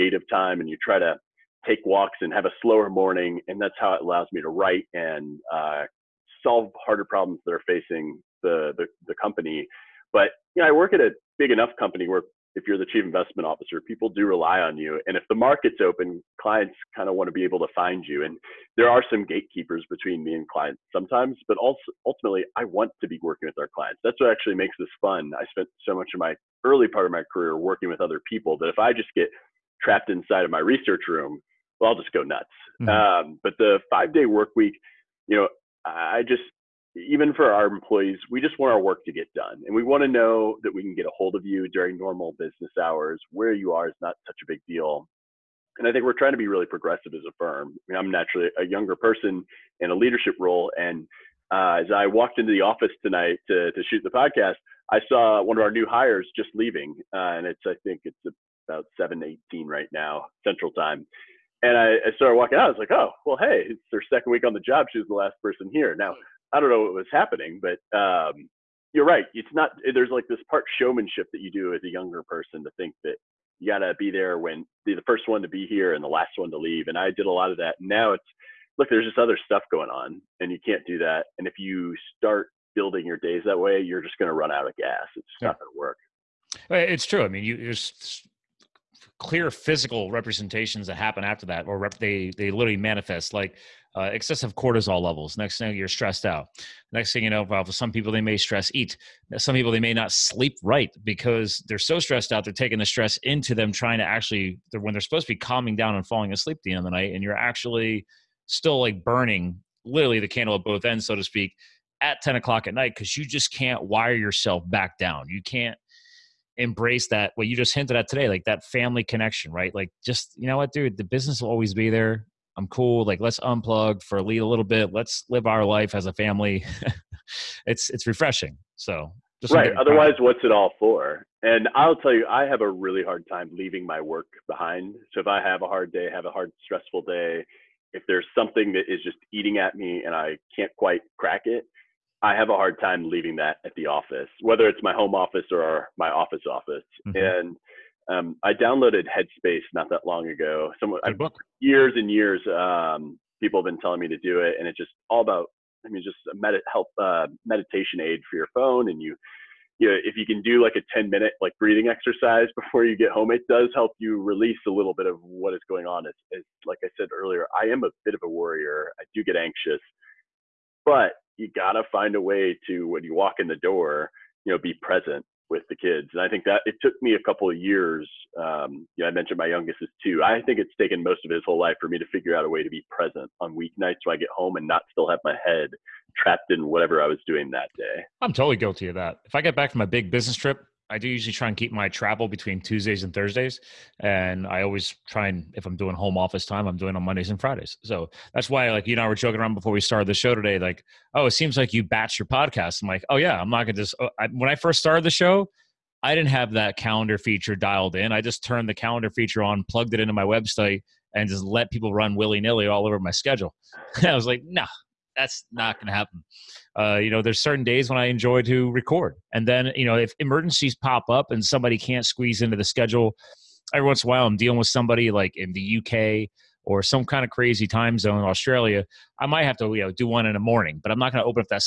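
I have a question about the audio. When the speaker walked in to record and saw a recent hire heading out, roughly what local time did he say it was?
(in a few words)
7:18.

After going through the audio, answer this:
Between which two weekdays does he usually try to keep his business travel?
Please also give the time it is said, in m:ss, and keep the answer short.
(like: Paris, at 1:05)
Tuesdays and Thursdays, at 3:12.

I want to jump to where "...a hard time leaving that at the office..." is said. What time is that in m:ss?
2:22.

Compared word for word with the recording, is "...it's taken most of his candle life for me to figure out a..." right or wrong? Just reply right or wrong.
wrong.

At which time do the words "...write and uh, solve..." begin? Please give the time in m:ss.
0:04.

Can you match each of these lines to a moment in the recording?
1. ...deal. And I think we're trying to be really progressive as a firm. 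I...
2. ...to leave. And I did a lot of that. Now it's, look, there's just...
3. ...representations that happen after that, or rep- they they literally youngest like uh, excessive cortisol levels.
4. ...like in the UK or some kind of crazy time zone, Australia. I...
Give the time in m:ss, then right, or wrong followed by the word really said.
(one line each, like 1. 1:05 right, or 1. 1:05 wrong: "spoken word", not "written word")
1. 0:44 right
2. 1:16 right
3. 1:30 wrong: "manifest", not "youngest"
4. 3:45 right.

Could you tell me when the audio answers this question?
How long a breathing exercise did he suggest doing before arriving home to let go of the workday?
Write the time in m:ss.
2:40.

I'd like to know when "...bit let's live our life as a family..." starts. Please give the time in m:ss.
2:04.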